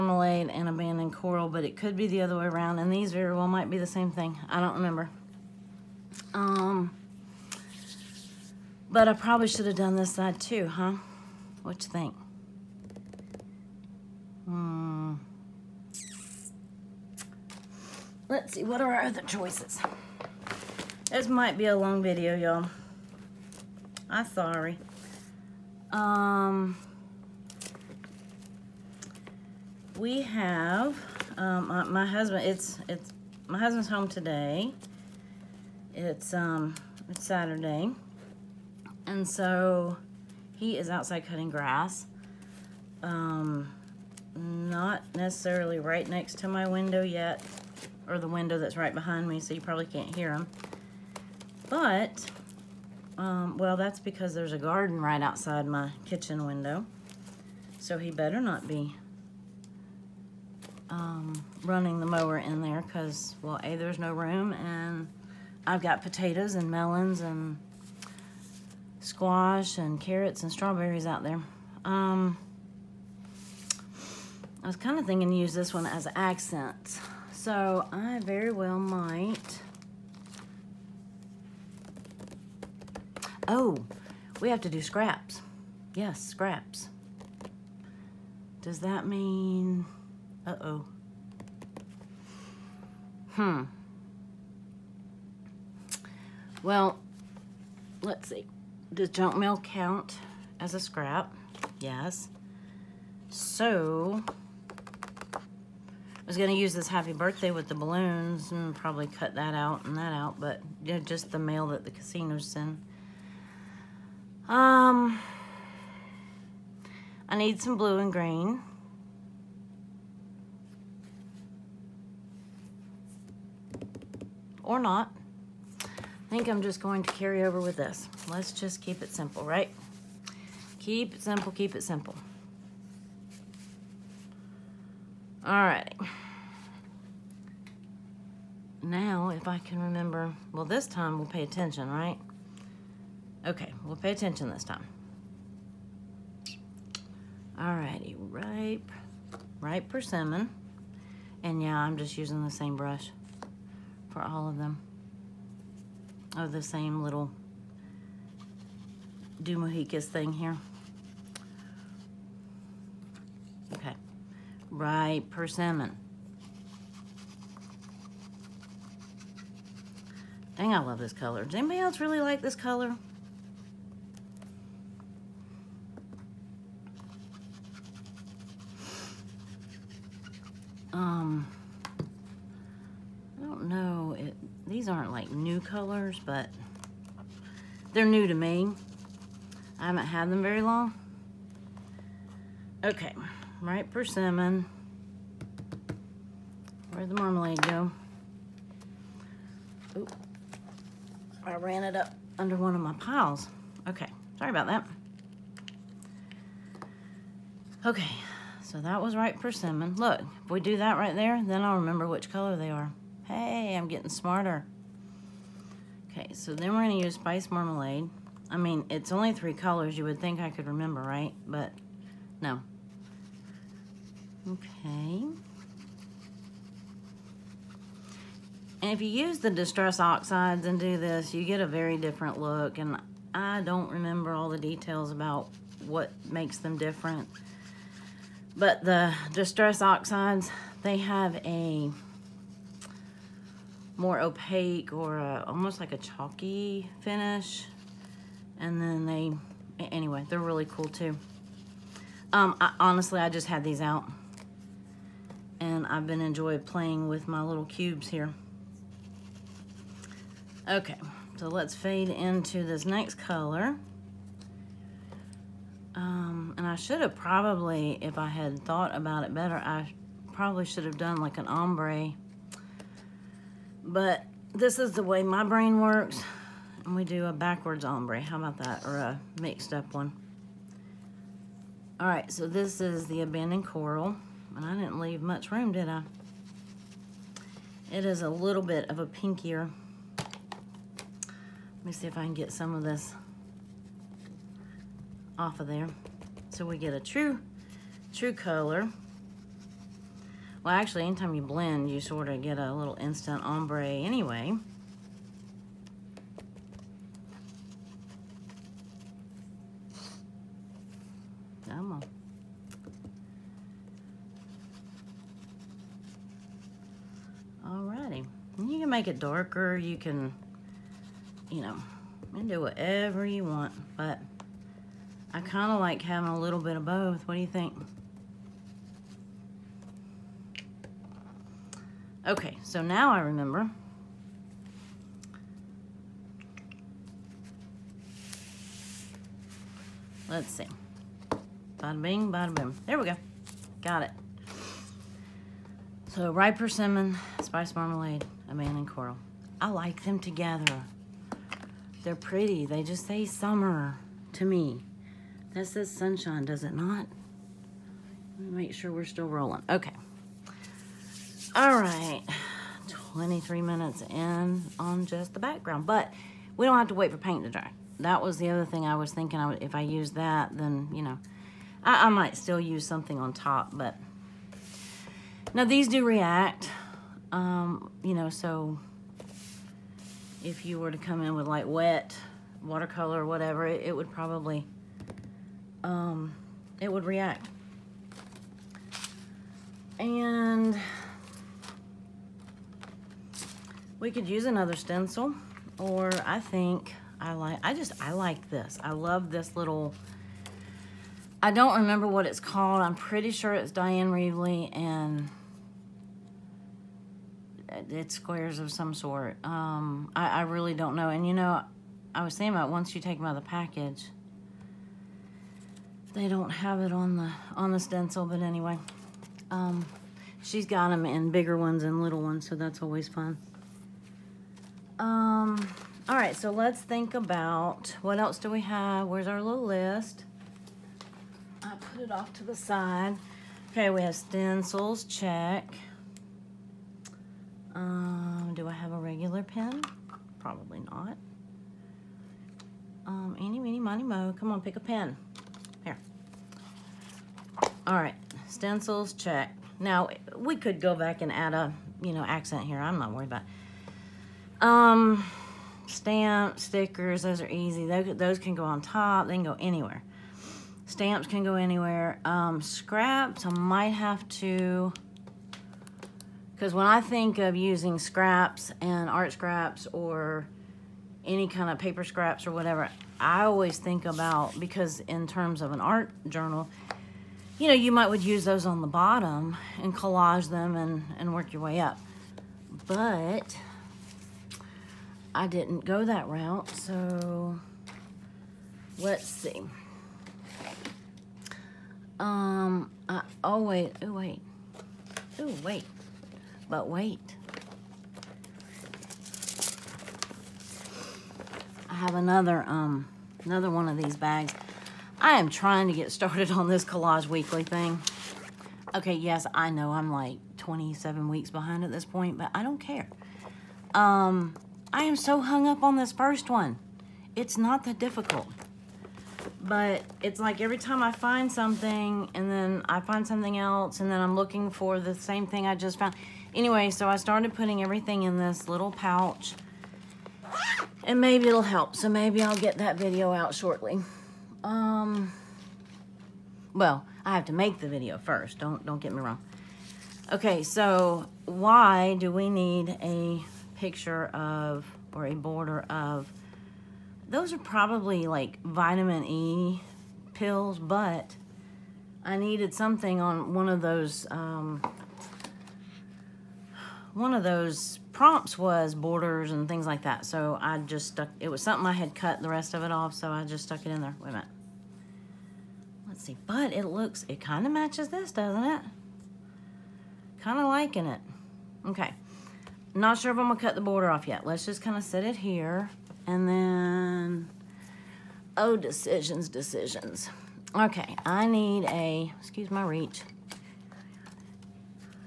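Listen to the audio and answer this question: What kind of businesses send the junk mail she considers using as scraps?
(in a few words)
casinos.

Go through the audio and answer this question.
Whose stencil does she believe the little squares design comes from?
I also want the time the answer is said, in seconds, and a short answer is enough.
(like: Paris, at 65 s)
Dyan Reaveley, at 403 s.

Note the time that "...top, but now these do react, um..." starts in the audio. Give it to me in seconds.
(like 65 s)
373 s.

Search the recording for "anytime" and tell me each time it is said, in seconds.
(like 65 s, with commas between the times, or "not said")
301 s.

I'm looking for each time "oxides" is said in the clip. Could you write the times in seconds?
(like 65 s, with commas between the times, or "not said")
230 s, 239 s.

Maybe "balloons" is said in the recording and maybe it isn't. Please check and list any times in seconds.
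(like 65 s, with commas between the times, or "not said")
107 s.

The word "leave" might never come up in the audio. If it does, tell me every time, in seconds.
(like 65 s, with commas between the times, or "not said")
284 s.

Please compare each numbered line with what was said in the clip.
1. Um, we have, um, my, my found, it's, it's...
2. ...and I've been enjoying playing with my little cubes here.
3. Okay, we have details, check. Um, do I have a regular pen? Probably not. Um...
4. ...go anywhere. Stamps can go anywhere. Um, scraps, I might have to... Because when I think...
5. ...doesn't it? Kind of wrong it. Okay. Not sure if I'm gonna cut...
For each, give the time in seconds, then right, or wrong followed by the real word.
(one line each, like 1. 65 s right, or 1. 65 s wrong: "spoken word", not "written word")
1. 25 s wrong: "husband", not "found"
2. 255 s right
3. 433 s wrong: "stencils", not "details"
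4. 459 s right
5. 568 s wrong: "liking", not "wrong".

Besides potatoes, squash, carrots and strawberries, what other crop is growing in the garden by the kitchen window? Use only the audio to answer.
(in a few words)
melons.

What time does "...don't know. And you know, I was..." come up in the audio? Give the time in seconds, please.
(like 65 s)
410 s.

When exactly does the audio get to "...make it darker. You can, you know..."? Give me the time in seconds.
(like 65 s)
318 s.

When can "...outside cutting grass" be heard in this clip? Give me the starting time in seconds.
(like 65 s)
40 s.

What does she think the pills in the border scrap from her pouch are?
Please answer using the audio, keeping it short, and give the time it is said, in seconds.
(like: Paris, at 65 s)
vitamin E pills, at 548 s.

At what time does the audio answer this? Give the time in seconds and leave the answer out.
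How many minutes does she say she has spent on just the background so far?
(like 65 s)
362 s.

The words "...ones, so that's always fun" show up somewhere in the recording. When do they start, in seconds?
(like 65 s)
422 s.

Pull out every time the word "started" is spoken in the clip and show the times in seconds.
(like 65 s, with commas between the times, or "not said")
506 s, 527 s.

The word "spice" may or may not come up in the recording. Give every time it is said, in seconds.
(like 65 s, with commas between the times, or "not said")
217 s, 347 s.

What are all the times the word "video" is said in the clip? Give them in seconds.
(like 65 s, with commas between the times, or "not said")
22 s, 532 s, 537 s.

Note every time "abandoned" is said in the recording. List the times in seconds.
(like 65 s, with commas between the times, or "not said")
0 s, 283 s, 348 s.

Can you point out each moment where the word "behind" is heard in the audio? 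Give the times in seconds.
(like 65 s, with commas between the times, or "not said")
48 s, 511 s.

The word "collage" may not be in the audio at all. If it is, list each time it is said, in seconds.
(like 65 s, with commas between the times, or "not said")
479 s, 506 s.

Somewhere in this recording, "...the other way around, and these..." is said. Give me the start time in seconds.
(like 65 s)
2 s.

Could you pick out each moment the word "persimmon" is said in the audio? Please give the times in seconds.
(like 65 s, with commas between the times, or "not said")
149 s, 165 s, 193 s, 209 s, 346 s.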